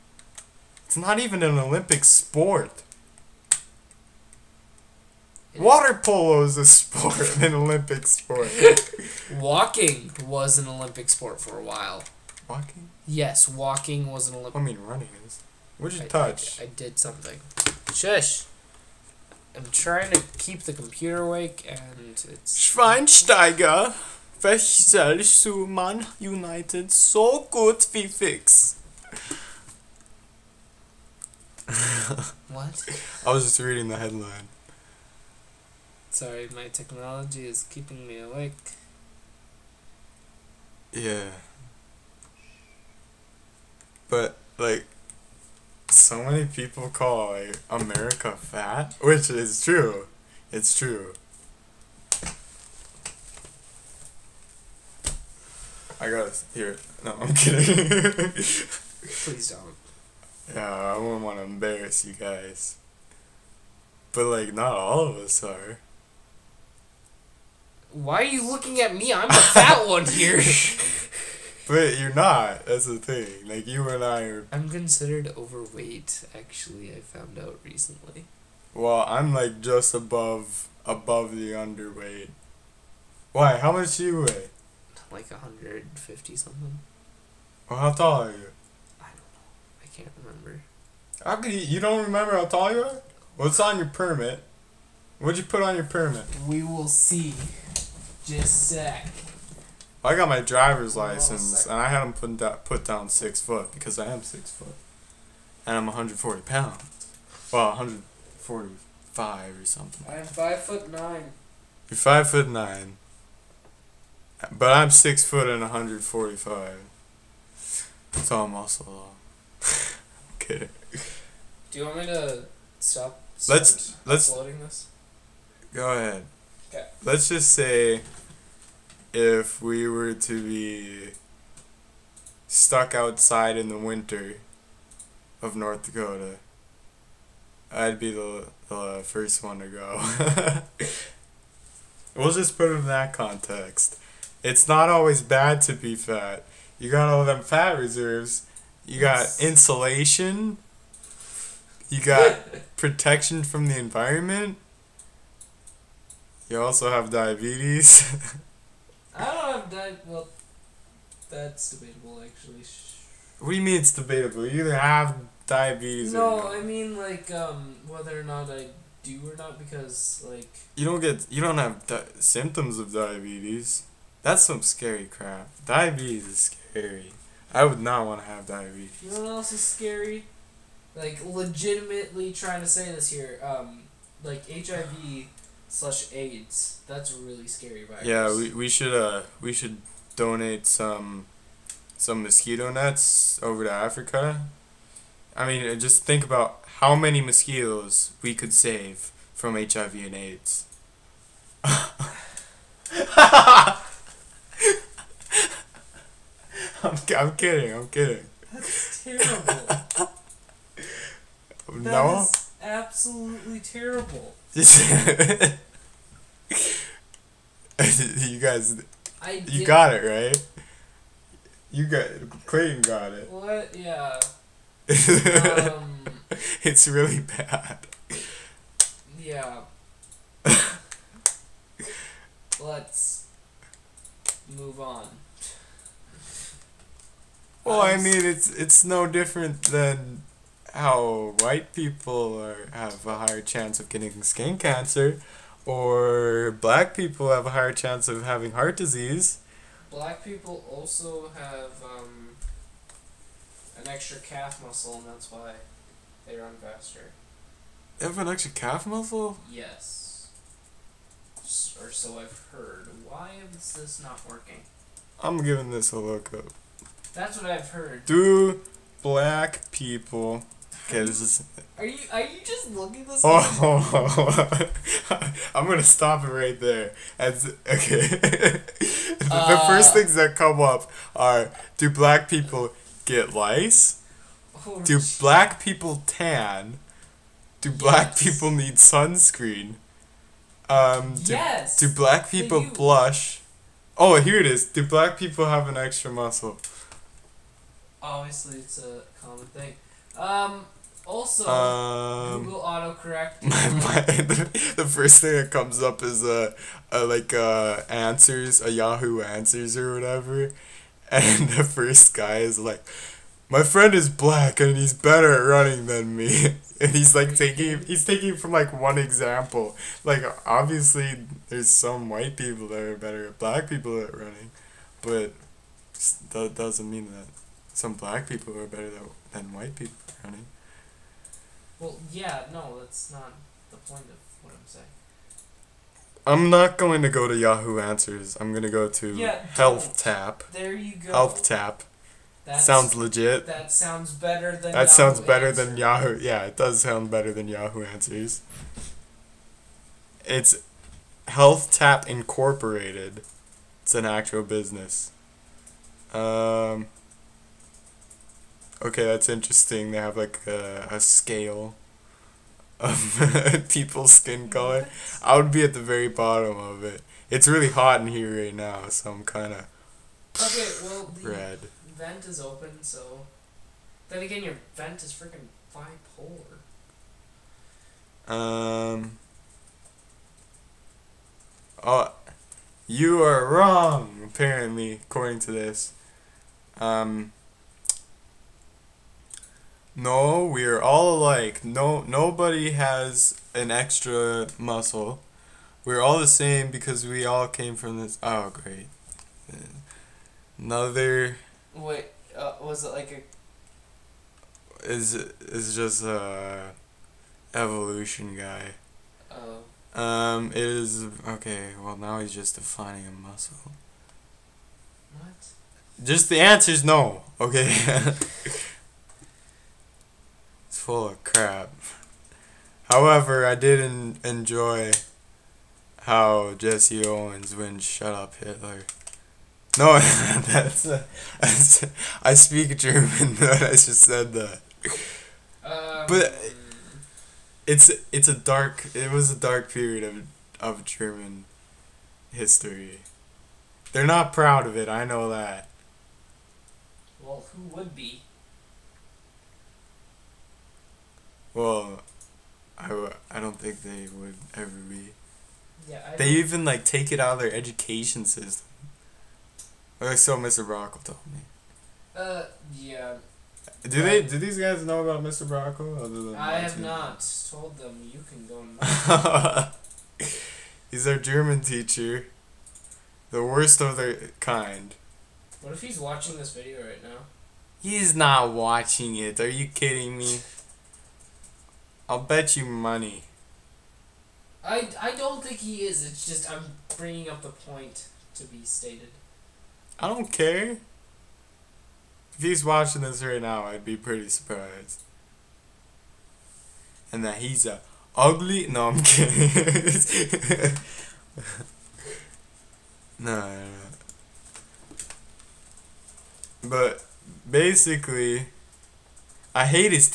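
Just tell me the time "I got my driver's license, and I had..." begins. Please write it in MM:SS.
01:40.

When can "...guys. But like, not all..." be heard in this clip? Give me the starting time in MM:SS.
01:02.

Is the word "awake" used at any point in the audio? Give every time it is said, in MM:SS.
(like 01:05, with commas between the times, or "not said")
00:21, 00:38.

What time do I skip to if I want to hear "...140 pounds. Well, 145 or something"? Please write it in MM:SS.
01:45.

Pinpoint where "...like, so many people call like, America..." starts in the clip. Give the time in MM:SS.
00:44.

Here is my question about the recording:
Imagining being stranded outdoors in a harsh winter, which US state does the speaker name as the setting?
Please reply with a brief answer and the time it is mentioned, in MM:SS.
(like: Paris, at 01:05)
North Dakota, at 02:15.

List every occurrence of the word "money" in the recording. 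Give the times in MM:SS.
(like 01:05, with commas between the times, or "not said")
08:02.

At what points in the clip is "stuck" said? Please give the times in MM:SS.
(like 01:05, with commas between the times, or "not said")
02:12.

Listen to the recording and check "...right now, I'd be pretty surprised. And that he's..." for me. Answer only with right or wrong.
right.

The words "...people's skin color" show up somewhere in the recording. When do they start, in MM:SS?
06:03.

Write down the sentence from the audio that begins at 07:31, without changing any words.
Well, I w- I don't think they would ever be.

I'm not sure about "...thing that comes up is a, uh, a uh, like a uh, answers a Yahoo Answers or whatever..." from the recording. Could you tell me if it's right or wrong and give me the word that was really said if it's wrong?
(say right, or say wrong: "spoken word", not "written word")
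right.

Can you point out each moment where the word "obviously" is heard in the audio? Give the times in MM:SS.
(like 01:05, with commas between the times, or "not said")
04:58, 05:20.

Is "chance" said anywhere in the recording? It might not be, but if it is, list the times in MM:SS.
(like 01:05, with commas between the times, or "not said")
04:03, 04:07.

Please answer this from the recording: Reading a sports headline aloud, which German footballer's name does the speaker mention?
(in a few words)
Schweinsteiger.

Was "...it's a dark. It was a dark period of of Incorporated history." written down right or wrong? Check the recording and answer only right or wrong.
wrong.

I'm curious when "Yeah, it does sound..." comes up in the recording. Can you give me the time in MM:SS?
05:46.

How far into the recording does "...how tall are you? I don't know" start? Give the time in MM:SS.
01:27.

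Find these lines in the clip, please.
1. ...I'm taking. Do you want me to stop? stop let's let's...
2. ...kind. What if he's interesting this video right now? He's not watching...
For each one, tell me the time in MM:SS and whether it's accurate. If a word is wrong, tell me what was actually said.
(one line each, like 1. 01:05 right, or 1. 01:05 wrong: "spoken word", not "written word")
1. 01:59 wrong: "kidding", not "taking"
2. 07:54 wrong: "watching", not "interesting".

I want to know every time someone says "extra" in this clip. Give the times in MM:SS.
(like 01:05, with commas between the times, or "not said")
04:13, 04:18, 04:55, 06:33.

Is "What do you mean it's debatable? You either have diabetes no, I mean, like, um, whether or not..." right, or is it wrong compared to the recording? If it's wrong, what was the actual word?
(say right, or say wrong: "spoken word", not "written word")
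right.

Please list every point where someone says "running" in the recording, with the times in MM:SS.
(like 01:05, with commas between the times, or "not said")
00:14, 05:15, 05:24.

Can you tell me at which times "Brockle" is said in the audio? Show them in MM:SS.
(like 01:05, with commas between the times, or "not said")
07:40, 07:45.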